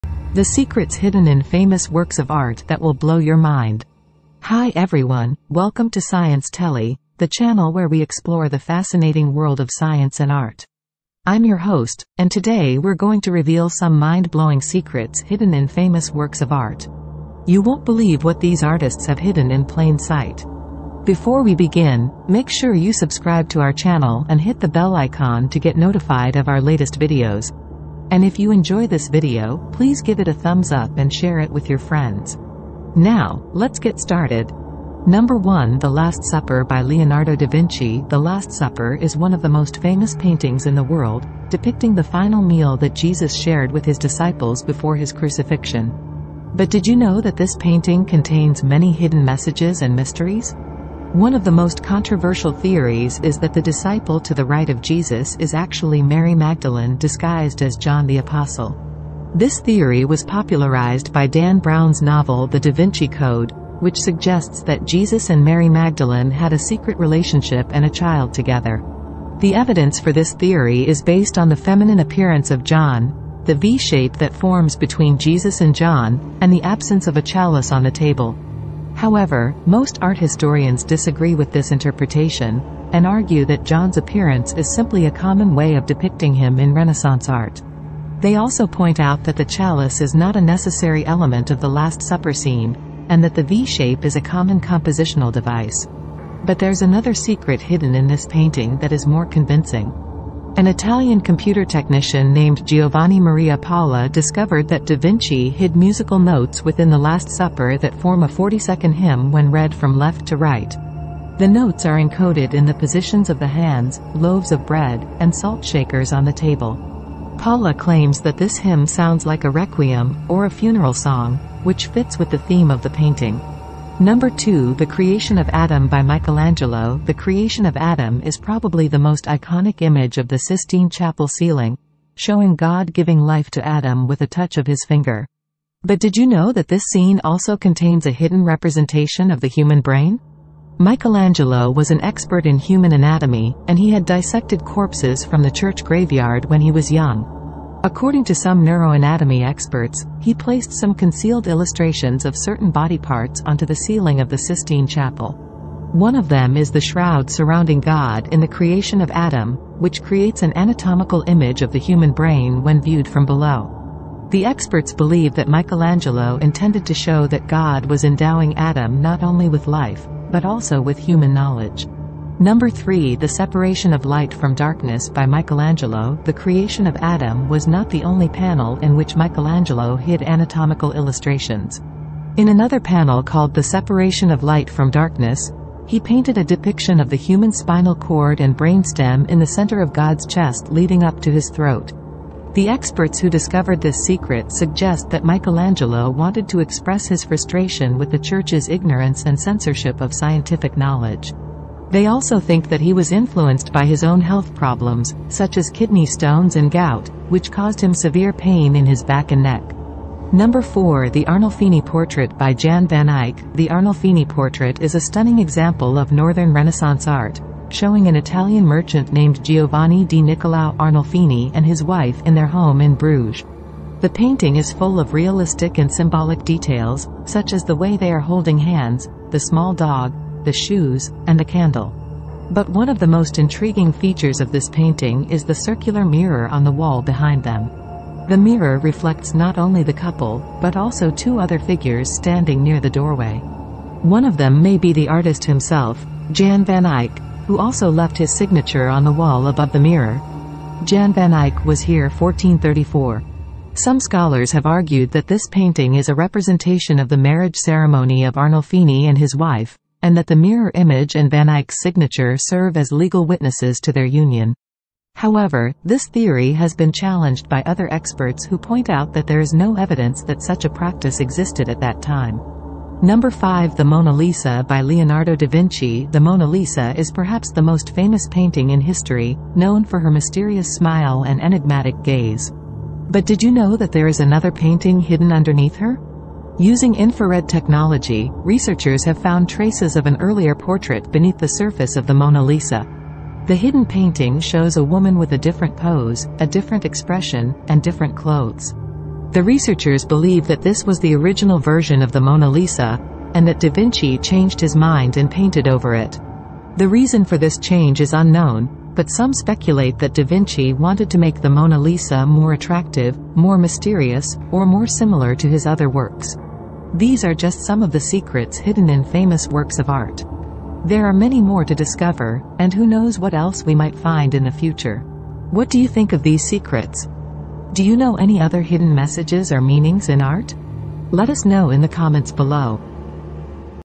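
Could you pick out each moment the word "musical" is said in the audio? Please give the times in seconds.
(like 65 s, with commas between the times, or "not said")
105 s.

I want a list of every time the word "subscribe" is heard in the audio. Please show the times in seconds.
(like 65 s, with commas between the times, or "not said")
22 s.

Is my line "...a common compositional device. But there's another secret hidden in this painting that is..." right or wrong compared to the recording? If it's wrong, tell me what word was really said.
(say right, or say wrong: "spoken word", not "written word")
right.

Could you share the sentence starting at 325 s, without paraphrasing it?
What do you think of these secrets?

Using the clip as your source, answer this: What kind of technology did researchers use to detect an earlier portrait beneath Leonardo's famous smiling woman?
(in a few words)
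Infrared.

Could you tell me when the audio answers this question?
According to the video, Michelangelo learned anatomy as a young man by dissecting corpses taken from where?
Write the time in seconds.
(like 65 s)
145 s.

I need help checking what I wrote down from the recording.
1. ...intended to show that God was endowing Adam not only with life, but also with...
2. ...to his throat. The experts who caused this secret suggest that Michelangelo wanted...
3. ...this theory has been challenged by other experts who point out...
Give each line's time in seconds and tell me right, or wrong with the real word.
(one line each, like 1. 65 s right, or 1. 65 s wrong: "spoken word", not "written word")
1. 166 s right
2. 191 s wrong: "discovered", not "caused"
3. 265 s right.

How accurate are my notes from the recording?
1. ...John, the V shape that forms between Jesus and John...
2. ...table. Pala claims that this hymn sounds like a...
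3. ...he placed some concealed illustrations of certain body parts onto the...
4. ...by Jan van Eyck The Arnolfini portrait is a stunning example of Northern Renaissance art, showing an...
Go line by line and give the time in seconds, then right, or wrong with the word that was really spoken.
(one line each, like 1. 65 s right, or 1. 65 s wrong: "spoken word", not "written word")
1. 72 s right
2. 116 s right
3. 150 s right
4. 212 s right.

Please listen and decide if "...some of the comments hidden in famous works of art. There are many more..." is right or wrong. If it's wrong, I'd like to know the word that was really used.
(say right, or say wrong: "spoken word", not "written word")
wrong: "secrets", not "comments".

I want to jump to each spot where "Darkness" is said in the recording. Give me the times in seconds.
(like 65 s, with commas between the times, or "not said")
174 s, 184 s.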